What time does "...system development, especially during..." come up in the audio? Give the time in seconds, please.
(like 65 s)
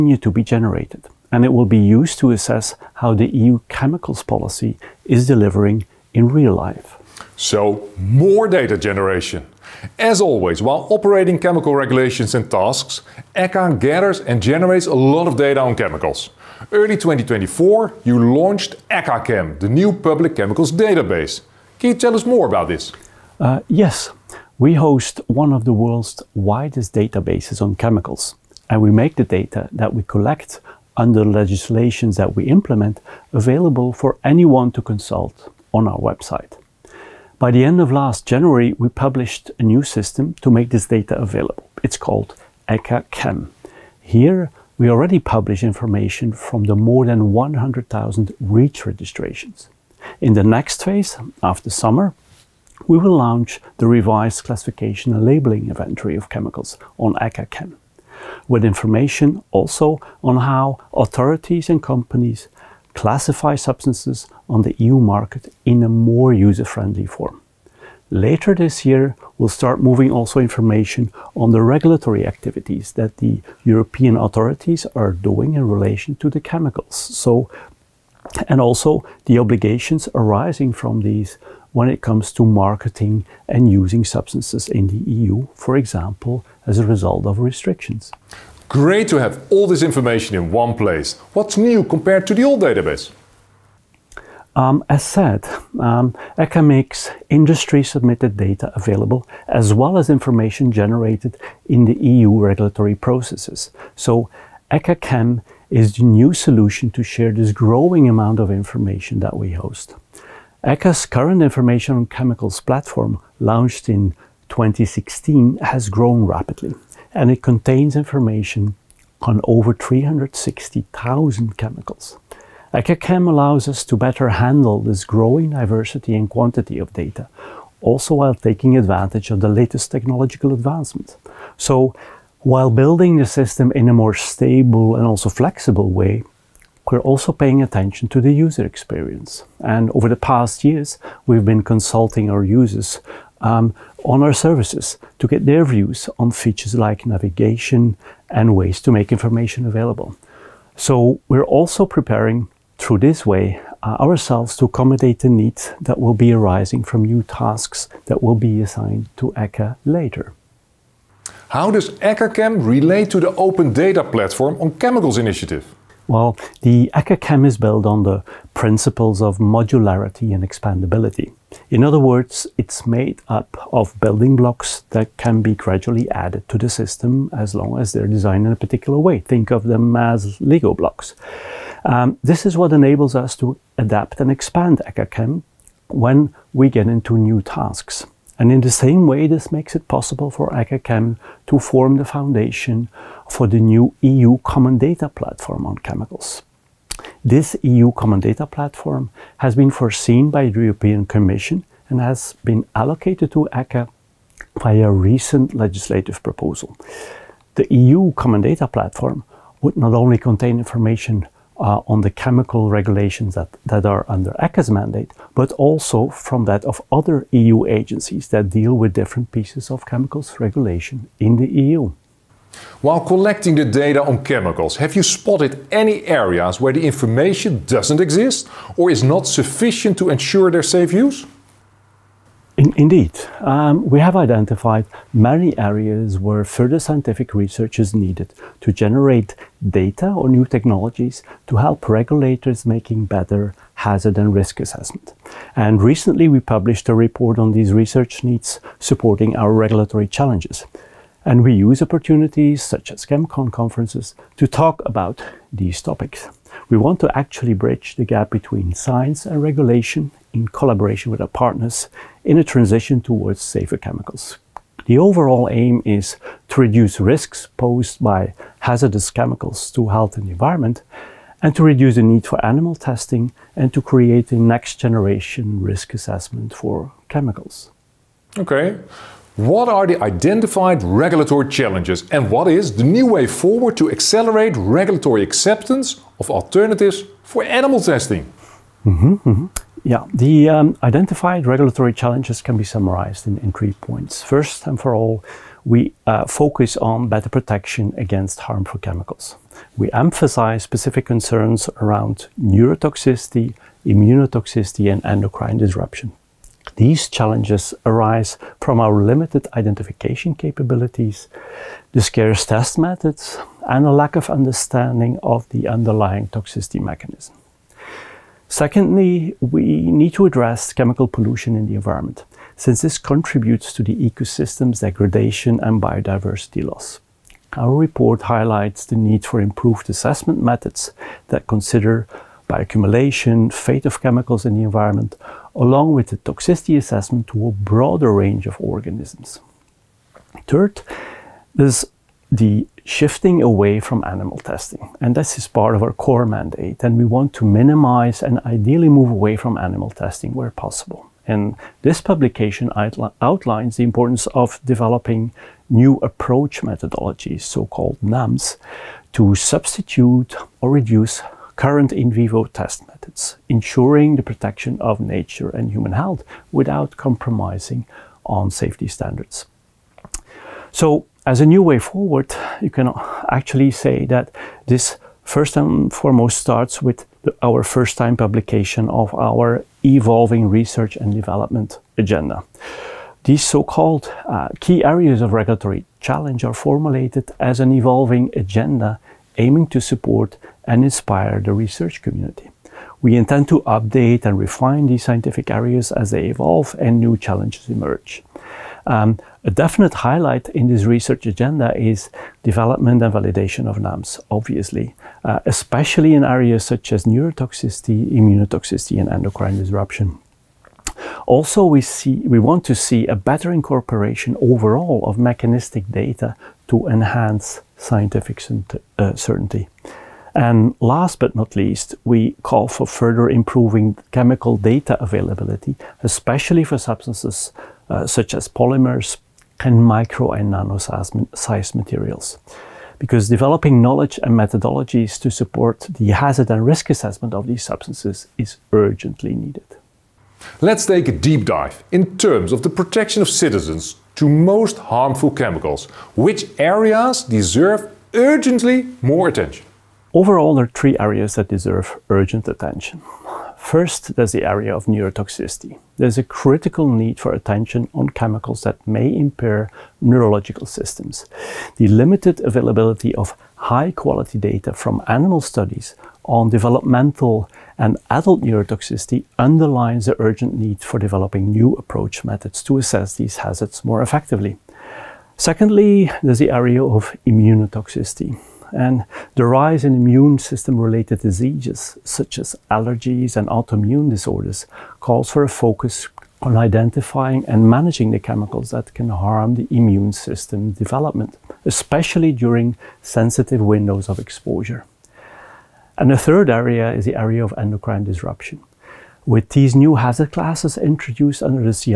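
490 s.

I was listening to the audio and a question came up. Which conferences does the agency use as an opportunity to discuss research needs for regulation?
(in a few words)
ChemCon.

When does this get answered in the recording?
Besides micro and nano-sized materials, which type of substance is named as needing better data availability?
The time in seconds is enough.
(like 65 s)
428 s.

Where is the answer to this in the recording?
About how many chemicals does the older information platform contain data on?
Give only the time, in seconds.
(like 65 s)
119 s.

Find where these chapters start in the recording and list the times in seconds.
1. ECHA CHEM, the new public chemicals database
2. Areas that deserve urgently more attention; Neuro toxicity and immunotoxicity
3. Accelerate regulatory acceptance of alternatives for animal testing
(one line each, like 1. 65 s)
1. 6 s
2. 439 s
3. 278 s.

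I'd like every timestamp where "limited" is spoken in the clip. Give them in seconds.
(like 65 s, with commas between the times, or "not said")
309 s, 461 s.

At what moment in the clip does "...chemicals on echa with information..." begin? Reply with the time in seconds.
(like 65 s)
56 s.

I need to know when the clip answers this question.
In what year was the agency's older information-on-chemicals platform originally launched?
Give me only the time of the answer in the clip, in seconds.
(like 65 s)
114 s.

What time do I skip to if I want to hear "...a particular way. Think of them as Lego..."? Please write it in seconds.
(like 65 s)
178 s.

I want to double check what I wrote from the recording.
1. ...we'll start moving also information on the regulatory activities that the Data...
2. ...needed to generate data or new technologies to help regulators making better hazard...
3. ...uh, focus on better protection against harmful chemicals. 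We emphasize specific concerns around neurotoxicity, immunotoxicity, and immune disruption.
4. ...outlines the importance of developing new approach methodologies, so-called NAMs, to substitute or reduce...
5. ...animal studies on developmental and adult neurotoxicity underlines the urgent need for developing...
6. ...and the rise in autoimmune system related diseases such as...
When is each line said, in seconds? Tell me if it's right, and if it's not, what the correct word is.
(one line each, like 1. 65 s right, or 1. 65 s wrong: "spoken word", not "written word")
1. 69 s wrong: "European", not "Data"
2. 237 s right
3. 296 s wrong: "endocrine", not "immune"
4. 353 s right
5. 465 s right
6. 478 s wrong: "immune", not "autoimmune".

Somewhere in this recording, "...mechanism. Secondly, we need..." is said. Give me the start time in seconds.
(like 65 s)
316 s.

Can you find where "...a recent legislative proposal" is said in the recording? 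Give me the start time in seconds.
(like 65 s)
204 s.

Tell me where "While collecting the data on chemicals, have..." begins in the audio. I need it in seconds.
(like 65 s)
222 s.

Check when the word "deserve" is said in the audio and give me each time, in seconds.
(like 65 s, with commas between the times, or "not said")
447 s, 451 s.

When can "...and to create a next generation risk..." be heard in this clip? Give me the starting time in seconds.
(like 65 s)
273 s.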